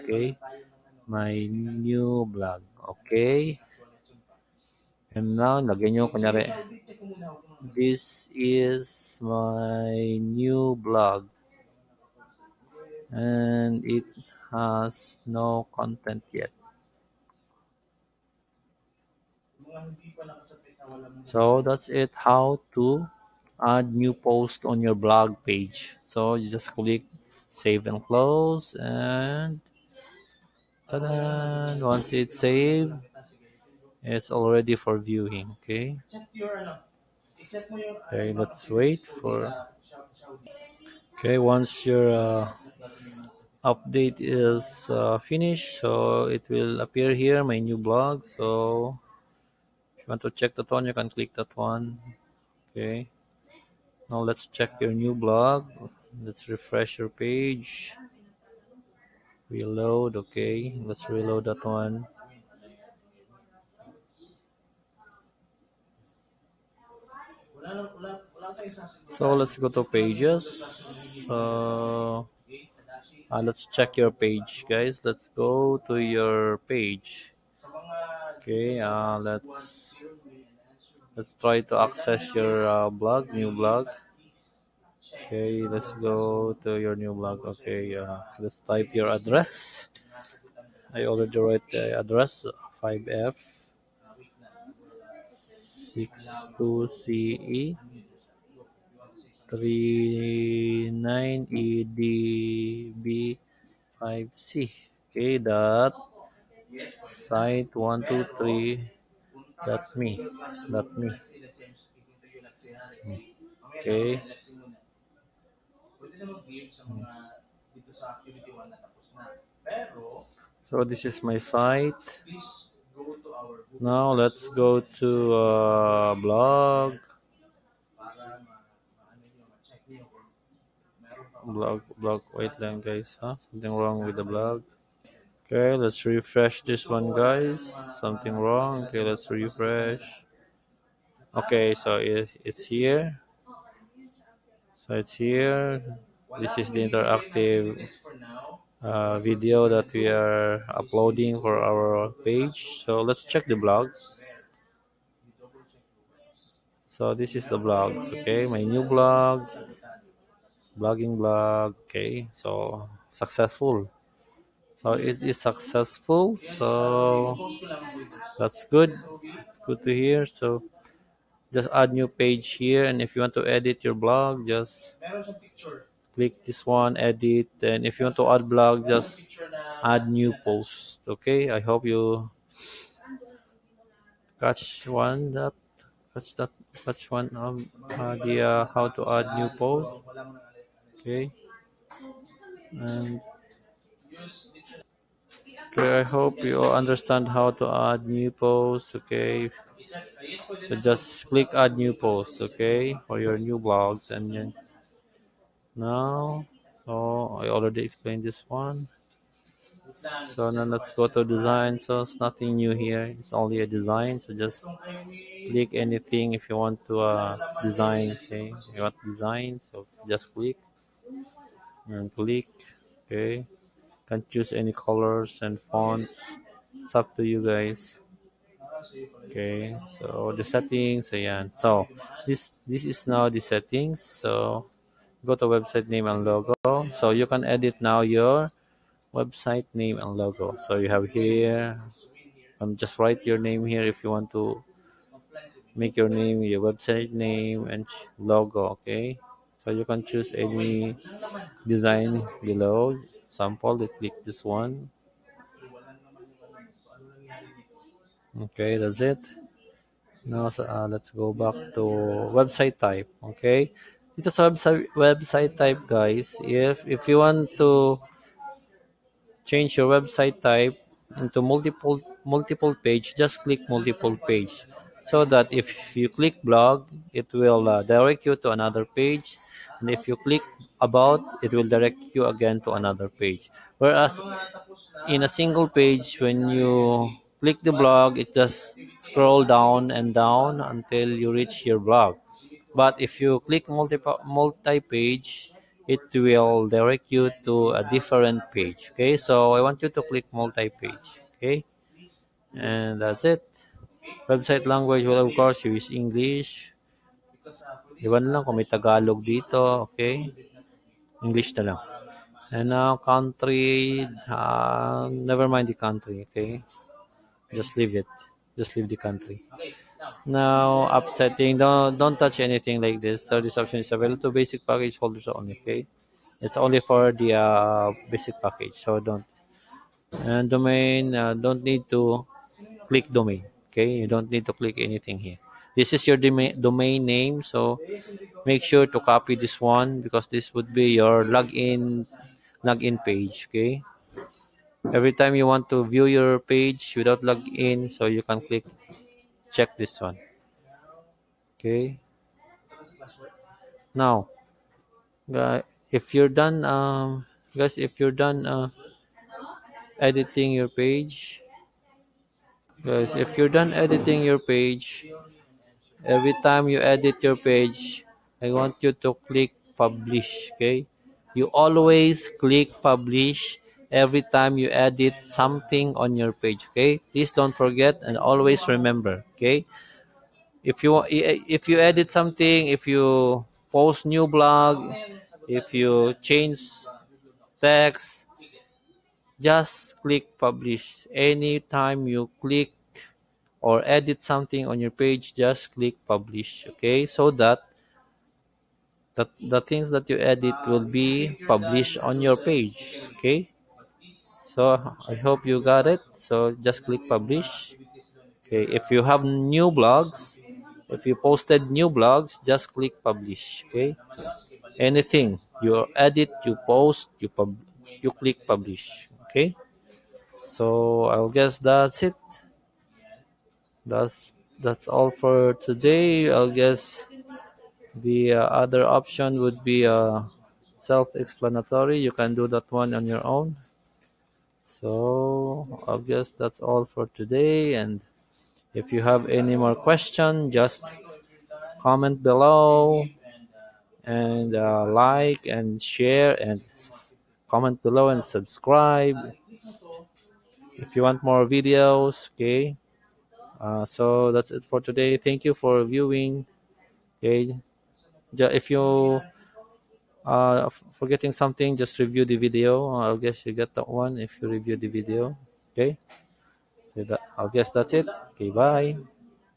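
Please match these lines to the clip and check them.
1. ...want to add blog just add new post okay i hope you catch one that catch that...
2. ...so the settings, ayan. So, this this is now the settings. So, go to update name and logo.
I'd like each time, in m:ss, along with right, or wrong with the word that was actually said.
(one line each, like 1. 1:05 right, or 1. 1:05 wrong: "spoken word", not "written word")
1. 2:58 right
2. 3:49 wrong: "website", not "update".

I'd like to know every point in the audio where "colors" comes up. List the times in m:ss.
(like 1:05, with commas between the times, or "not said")
3:44.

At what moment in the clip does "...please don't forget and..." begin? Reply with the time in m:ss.
6:17.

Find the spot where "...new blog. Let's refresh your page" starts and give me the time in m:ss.
0:54.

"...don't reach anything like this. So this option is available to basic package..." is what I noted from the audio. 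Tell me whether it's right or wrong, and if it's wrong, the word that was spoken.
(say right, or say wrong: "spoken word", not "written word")
wrong: "touch", not "reach".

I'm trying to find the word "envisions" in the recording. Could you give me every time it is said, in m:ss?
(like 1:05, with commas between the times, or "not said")
not said.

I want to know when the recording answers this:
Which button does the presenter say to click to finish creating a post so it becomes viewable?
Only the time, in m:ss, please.
0:27.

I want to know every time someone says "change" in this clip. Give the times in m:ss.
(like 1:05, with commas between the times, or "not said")
4:29, 6:26.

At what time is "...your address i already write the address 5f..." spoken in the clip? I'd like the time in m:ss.
1:28.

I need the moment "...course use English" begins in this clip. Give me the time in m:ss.
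5:05.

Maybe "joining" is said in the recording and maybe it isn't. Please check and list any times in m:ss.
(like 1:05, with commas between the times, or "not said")
not said.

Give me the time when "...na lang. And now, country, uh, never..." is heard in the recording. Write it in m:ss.
5:11.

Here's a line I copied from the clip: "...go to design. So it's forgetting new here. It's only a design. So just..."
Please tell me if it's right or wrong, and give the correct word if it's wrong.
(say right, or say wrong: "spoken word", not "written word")
wrong: "nothing", not "forgetting".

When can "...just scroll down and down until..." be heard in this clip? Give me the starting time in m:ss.
4:48.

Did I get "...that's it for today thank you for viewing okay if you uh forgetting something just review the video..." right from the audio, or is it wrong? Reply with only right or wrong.
right.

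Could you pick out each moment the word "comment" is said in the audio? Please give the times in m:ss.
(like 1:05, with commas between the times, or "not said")
7:21, 7:27.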